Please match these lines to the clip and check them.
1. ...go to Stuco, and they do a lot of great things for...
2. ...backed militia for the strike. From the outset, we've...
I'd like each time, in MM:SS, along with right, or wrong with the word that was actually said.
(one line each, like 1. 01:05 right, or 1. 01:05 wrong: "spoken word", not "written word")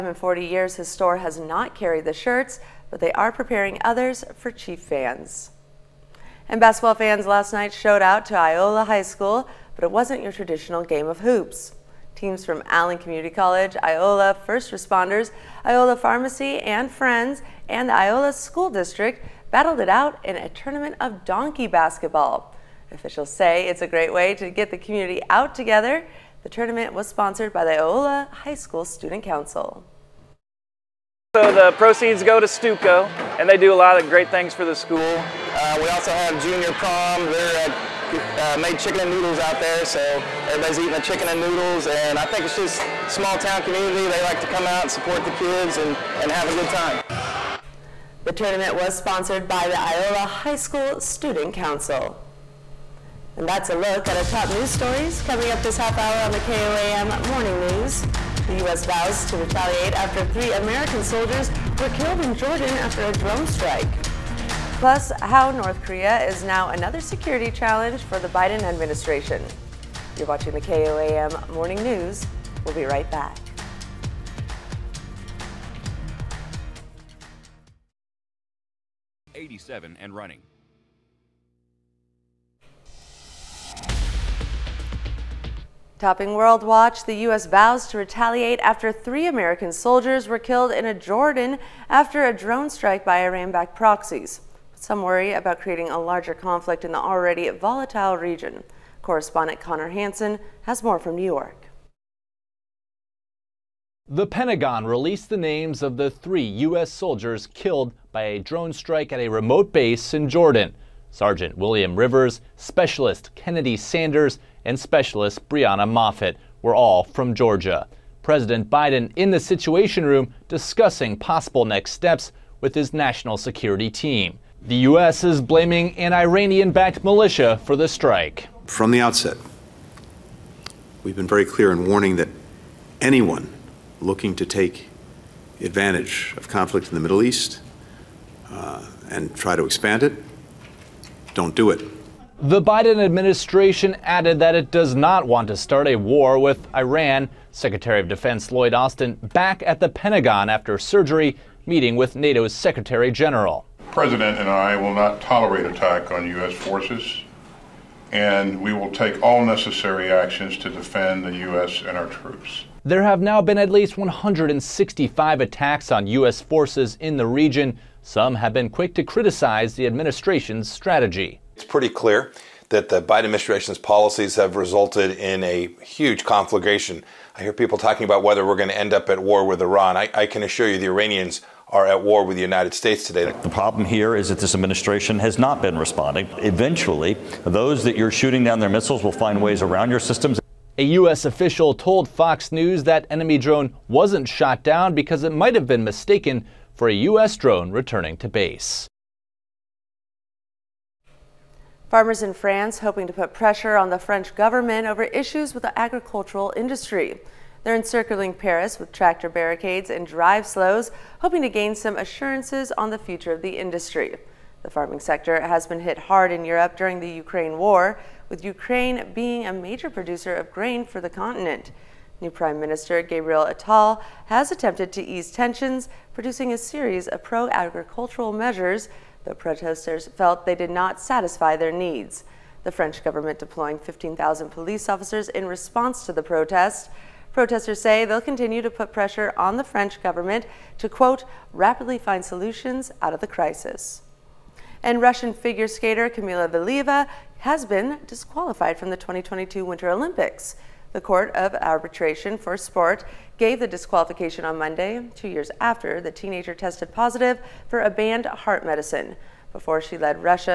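1. 00:32 right
2. 02:06 right.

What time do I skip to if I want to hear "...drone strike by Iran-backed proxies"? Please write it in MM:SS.
01:32.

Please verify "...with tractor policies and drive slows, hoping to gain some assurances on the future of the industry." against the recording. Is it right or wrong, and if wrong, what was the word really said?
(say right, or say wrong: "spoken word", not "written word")
wrong: "barricades", not "policies".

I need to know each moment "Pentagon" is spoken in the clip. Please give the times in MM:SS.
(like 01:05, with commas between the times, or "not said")
01:44, 02:29.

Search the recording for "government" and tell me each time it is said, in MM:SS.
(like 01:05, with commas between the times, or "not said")
03:24, 03:53, 04:00.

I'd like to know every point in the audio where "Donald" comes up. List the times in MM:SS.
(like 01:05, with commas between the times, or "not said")
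not said.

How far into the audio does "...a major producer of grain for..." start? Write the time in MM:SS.
03:39.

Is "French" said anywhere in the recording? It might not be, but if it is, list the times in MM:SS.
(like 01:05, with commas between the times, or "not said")
03:23, 03:52, 03:59.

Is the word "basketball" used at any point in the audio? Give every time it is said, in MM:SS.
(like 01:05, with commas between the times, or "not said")
00:06, 00:21.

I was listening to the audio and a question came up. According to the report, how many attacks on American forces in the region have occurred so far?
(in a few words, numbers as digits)
165.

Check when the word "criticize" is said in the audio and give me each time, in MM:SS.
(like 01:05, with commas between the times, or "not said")
02:49.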